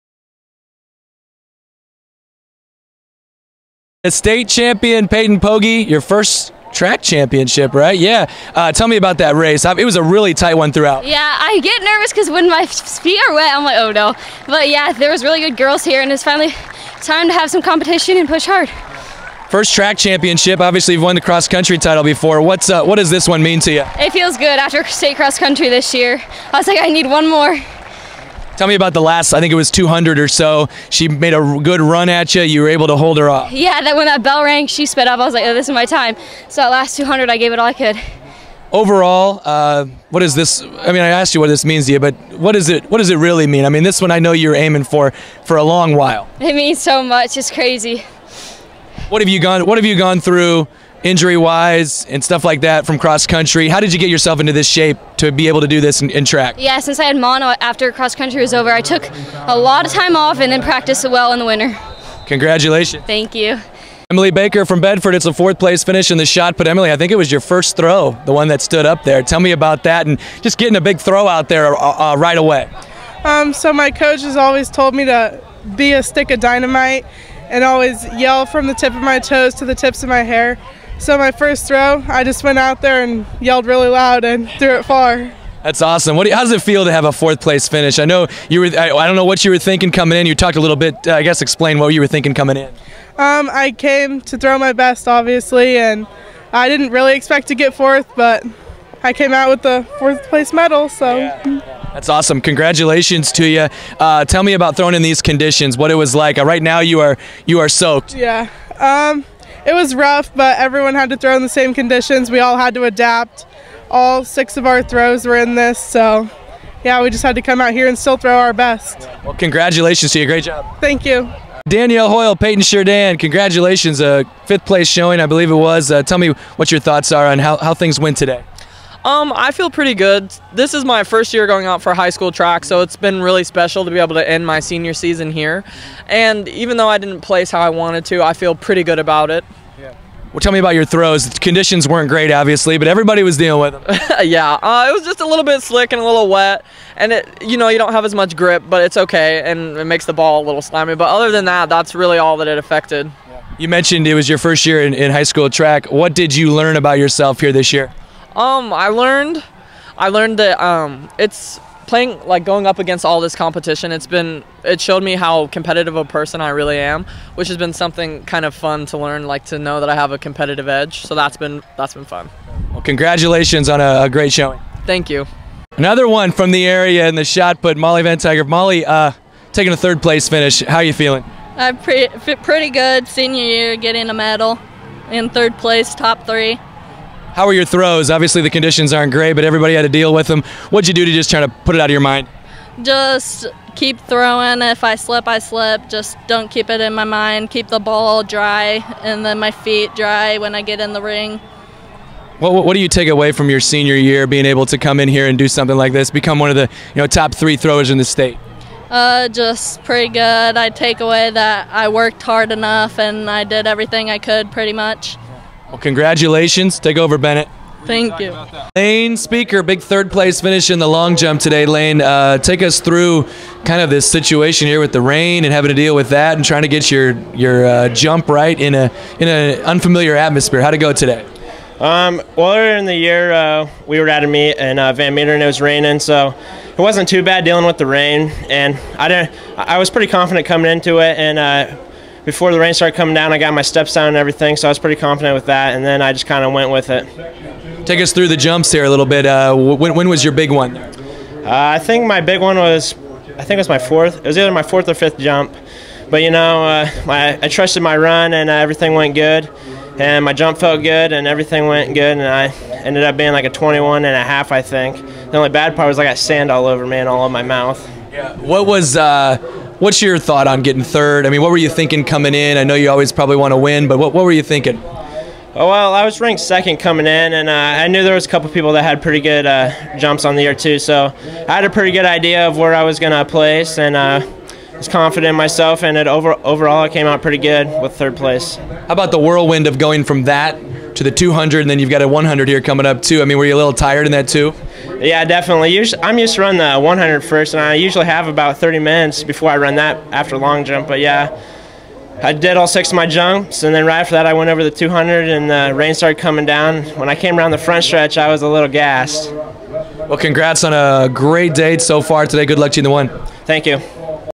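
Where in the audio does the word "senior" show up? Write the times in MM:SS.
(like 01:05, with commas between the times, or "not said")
02:14, 03:03, 03:23.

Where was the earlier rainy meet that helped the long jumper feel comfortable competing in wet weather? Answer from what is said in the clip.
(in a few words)
Van Meter.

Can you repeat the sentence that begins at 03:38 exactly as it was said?
Lane Speaker, big third place finish in the long jump today.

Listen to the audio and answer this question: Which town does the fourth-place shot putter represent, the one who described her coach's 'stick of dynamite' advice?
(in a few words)
Bedford.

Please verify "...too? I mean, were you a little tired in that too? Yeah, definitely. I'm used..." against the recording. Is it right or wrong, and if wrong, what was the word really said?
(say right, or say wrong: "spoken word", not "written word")
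right.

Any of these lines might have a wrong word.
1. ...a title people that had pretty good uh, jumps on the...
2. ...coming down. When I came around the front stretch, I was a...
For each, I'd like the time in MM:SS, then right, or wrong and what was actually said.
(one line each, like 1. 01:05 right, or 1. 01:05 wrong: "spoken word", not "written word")
1. 04:38 wrong: "couple", not "title"
2. 05:06 right.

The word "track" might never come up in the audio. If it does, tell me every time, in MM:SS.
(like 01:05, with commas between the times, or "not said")
00:06, 00:19, 00:56, 02:12, 02:35.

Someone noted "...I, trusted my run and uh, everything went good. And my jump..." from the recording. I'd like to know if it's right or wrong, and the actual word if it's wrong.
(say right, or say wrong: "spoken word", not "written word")
right.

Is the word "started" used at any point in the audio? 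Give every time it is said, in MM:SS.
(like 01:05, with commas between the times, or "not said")
04:02, 05:05.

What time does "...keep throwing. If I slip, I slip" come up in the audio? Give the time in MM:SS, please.
03:13.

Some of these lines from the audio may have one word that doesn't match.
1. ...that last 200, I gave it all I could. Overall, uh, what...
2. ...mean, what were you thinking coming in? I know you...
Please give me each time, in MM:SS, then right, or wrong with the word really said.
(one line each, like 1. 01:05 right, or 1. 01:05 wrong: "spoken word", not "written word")
1. 00:36 right
2. 04:31 right.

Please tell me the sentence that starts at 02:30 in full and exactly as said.
But other than that, that's really all that it affected.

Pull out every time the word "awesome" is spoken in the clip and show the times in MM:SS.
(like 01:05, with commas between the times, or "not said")
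01:25, 01:42.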